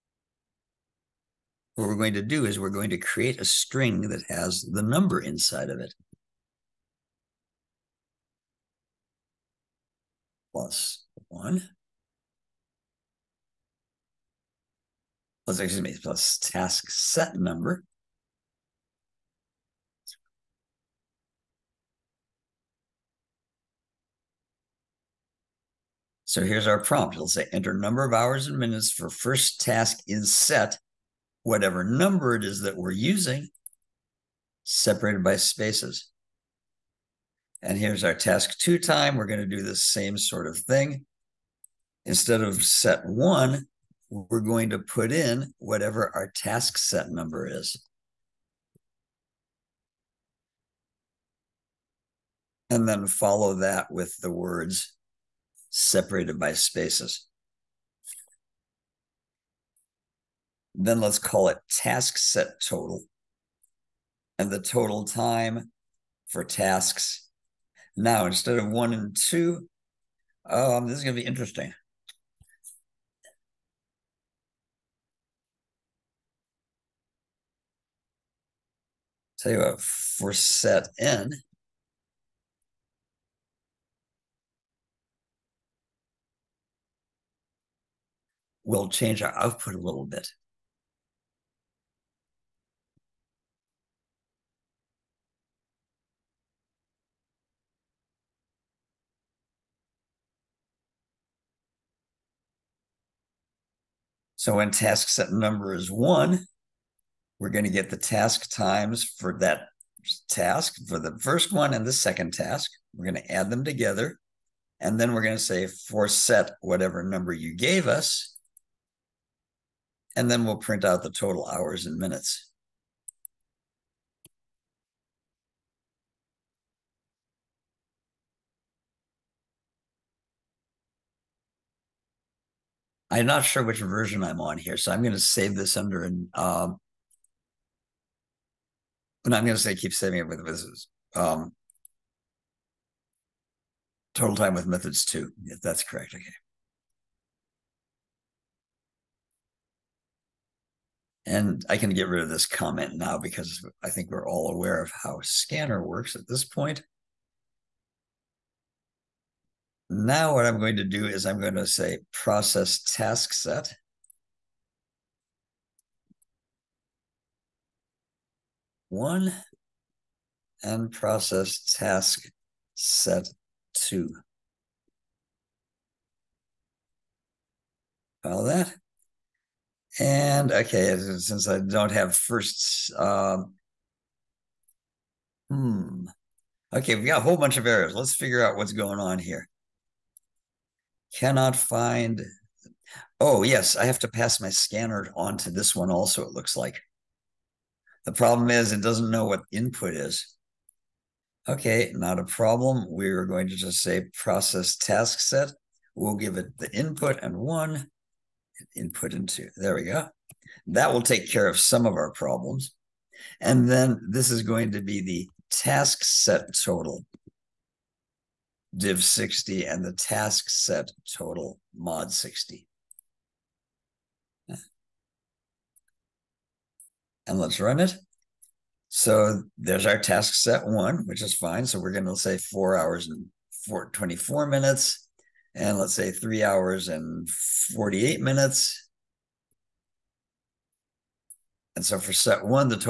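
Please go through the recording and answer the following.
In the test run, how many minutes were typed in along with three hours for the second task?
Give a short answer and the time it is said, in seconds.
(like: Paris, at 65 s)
48, at 237 s.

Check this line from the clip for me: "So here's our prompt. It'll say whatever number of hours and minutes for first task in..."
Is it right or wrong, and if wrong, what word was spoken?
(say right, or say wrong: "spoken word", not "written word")
wrong: "enter", not "whatever".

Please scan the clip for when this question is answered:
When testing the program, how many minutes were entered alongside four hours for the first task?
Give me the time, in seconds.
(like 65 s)
233 s.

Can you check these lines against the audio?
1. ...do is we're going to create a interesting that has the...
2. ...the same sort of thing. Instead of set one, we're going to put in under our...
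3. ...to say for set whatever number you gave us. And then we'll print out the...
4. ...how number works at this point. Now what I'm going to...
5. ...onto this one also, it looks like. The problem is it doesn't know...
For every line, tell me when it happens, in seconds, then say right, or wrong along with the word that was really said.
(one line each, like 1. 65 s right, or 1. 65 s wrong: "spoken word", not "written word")
1. 2 s wrong: "string", not "interesting"
2. 39 s wrong: "whatever", not "under"
3. 115 s right
4. 155 s wrong: "scanner", not "number"
5. 195 s right.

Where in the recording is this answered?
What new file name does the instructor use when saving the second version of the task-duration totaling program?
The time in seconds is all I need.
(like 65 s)
144 s.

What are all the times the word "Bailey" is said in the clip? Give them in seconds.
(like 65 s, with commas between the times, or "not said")
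not said.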